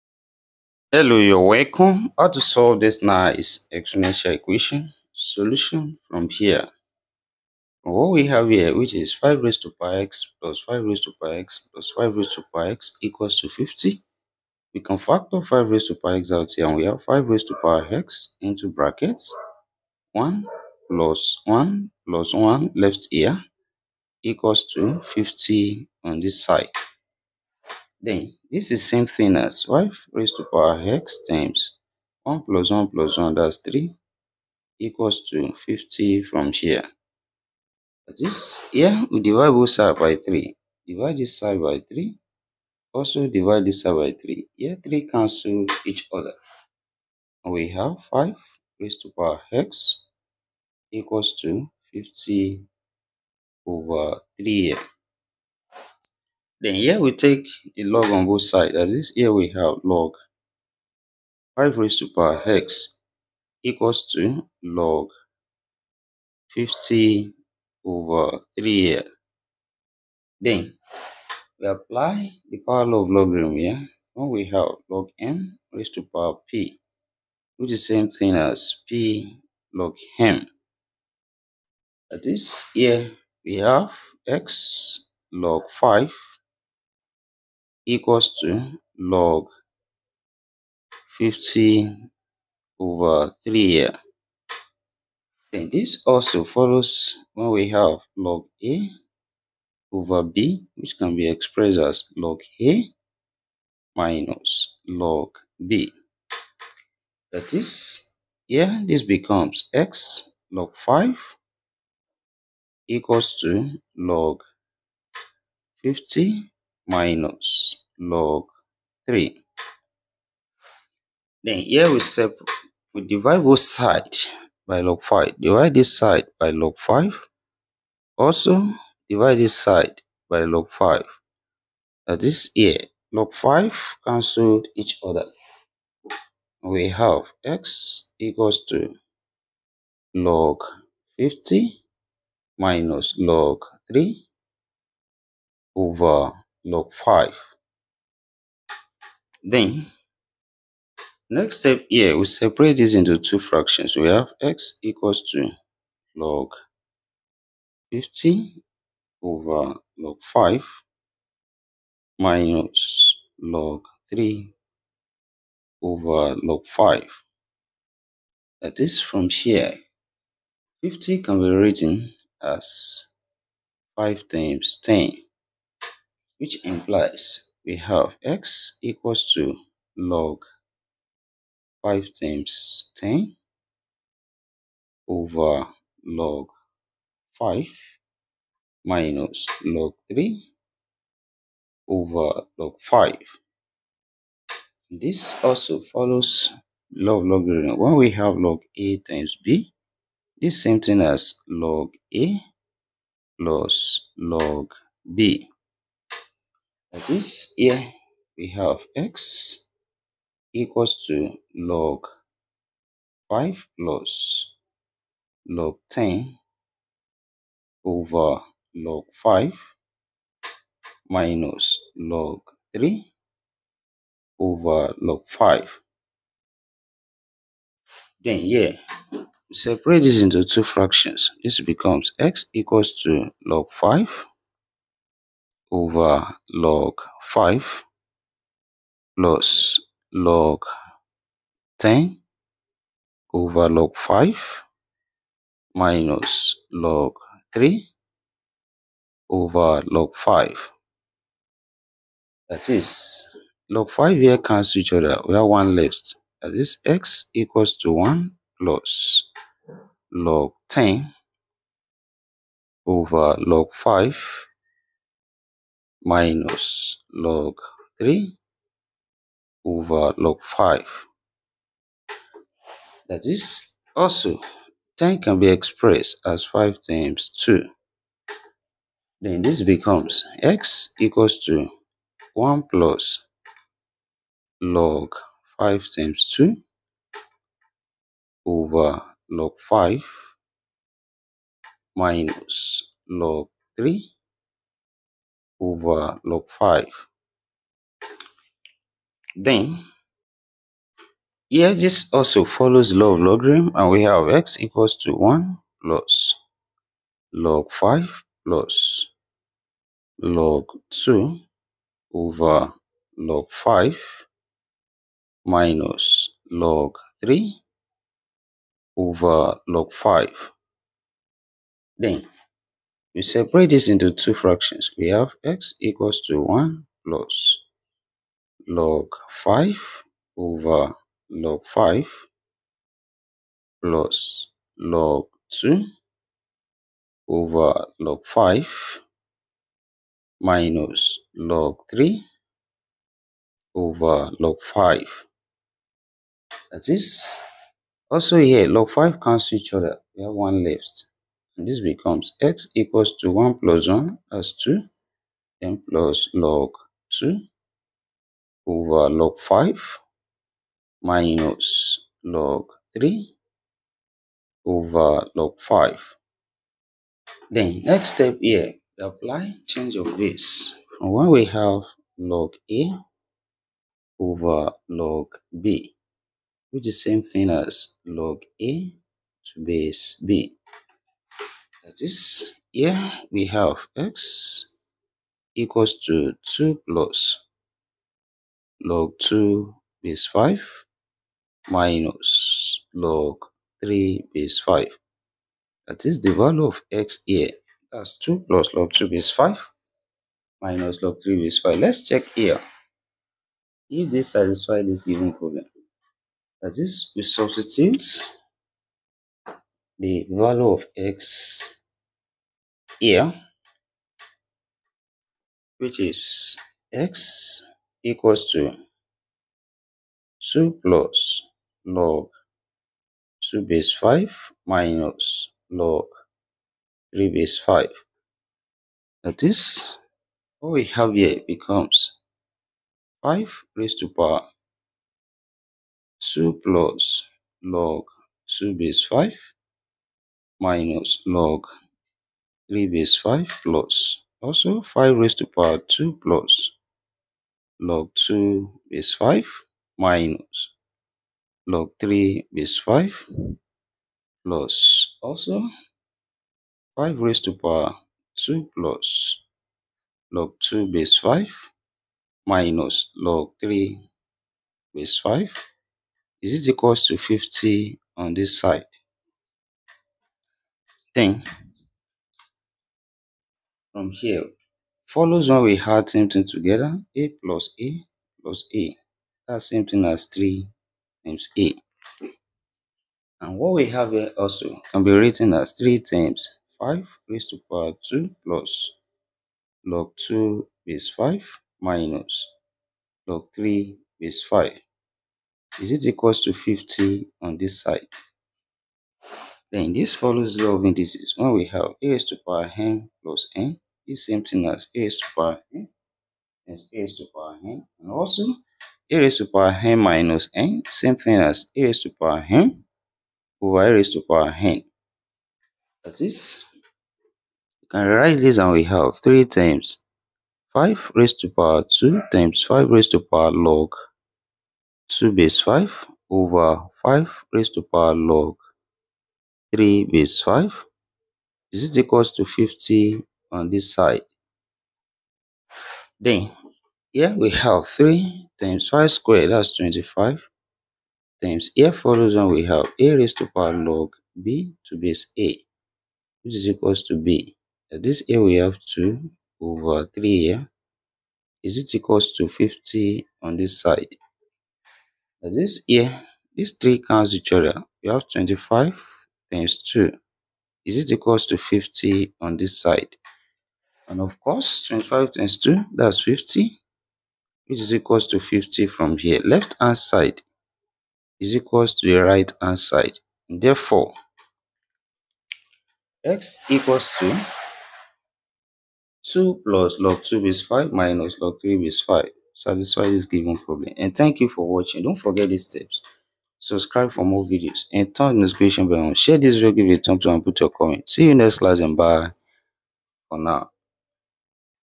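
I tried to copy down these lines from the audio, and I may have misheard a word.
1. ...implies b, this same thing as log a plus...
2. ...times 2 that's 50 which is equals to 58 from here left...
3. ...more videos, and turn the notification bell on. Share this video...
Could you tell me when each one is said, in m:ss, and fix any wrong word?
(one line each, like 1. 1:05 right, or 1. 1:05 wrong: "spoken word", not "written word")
1. 3:18 wrong: "times", not "implies"
2. 9:25 wrong: "50", not "58"
3. 9:47 right.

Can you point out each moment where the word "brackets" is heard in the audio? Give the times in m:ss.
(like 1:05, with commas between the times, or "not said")
0:18.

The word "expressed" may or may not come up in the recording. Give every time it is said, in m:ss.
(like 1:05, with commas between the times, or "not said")
1:41, 4:35.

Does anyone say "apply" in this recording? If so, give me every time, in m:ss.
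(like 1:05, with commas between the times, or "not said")
1:11, 6:08.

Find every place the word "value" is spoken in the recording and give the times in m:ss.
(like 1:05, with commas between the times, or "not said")
6:36, 6:50.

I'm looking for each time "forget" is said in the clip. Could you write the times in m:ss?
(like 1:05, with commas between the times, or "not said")
9:45.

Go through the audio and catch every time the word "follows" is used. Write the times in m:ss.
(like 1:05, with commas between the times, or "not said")
1:36, 3:15, 5:02, 7:55, 8:20, 9:01.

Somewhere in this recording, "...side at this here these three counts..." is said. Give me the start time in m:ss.
9:13.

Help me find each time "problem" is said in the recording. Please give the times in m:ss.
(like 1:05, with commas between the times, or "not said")
6:45, 9:43.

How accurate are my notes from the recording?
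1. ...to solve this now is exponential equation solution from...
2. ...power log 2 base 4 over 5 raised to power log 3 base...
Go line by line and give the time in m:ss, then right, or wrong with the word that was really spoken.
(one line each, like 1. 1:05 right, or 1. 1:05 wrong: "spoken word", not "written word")
1. 0:02 right
2. 8:43 wrong: "5", not "4".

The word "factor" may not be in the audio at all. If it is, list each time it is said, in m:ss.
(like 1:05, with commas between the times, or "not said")
0:14.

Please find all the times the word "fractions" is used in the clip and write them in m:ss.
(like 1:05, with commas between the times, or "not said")
2:33, 3:50, 5:24.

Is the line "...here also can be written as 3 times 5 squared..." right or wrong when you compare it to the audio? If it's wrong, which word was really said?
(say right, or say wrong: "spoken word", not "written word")
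wrong: "raised", not "squared".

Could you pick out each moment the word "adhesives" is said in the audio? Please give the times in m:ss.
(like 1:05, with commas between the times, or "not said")
not said.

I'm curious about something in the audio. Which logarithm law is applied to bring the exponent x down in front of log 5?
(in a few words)
power law.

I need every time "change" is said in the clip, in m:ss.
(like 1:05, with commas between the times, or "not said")
6:09.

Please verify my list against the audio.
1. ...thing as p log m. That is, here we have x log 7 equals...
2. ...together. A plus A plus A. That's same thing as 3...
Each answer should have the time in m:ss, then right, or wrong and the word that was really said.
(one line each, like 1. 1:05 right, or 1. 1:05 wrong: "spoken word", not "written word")
1. 1:18 wrong: "5", not "7"
2. 7:56 right.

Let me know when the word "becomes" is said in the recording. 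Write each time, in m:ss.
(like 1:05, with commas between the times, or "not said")
1:49, 3:51, 4:39, 5:51, 7:11.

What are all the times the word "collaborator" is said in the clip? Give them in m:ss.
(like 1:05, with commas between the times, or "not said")
not said.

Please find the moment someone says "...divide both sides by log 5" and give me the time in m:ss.
2:03.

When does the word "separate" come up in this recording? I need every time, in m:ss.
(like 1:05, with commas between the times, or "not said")
2:32, 3:49, 5:23.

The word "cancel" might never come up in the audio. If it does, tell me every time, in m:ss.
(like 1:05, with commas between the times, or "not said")
0:45, 2:14, 4:14, 5:49.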